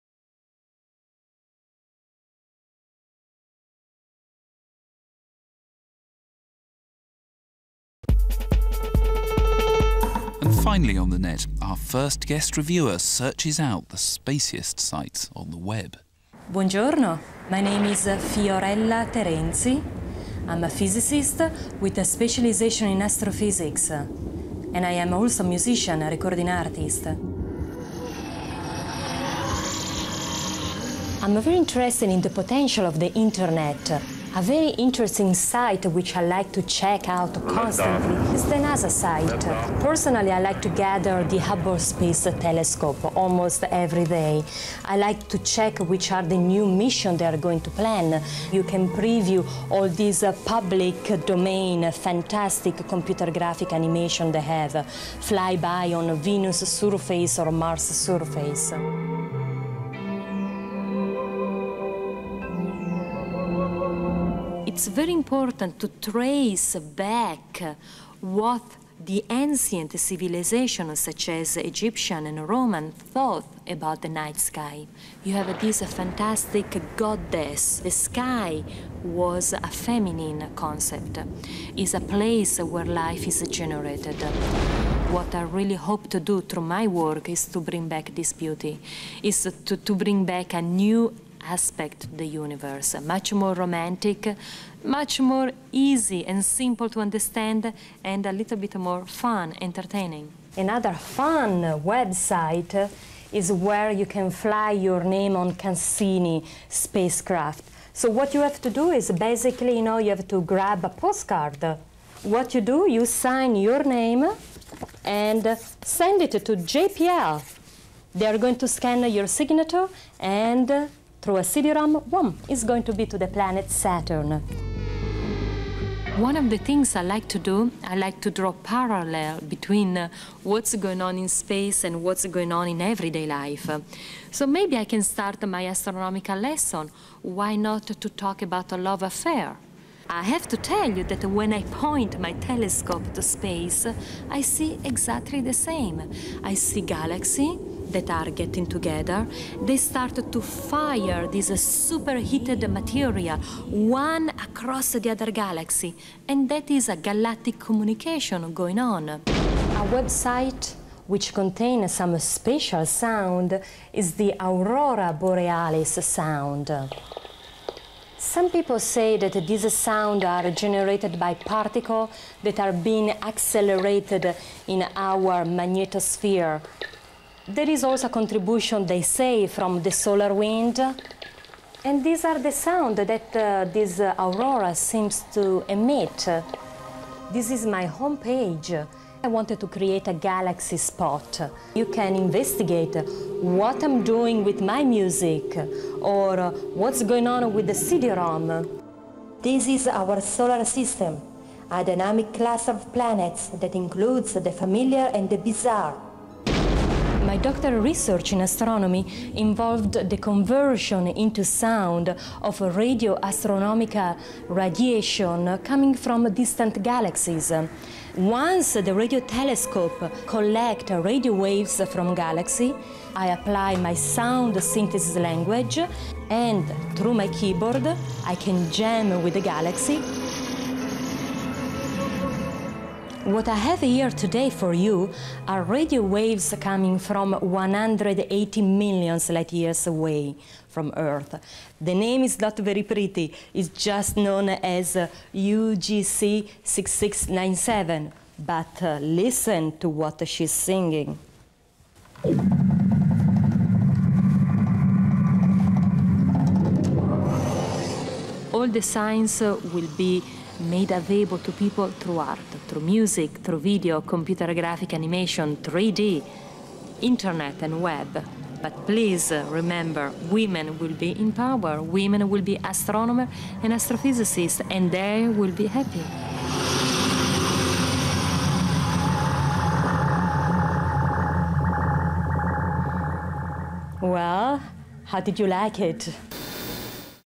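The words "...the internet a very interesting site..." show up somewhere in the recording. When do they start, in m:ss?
0:32.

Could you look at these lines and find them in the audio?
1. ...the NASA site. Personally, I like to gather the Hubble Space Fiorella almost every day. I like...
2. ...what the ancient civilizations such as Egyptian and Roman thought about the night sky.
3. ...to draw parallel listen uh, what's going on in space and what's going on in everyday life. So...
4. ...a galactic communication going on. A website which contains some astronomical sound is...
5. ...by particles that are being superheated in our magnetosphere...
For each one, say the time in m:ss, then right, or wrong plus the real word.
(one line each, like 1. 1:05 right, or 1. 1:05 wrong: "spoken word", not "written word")
1. 0:38 wrong: "Telescope", not "Fiorella"
2. 1:08 right
3. 2:08 wrong: "between", not "listen"
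4. 2:36 wrong: "special", not "astronomical"
5. 2:51 wrong: "accelerated", not "superheated".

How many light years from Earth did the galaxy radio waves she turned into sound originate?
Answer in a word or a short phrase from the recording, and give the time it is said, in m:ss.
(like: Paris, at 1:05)
180 million light years, at 3:57.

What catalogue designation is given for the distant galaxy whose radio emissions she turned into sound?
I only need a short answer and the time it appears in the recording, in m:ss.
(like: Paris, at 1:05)
UGC 6697, at 4:05.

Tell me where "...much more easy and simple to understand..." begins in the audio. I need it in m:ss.
1:34.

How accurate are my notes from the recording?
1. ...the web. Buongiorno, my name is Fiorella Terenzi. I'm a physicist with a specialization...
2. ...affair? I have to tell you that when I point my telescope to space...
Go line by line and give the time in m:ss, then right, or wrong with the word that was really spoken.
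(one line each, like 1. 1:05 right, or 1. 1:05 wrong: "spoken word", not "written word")
1. 0:15 right
2. 2:19 right.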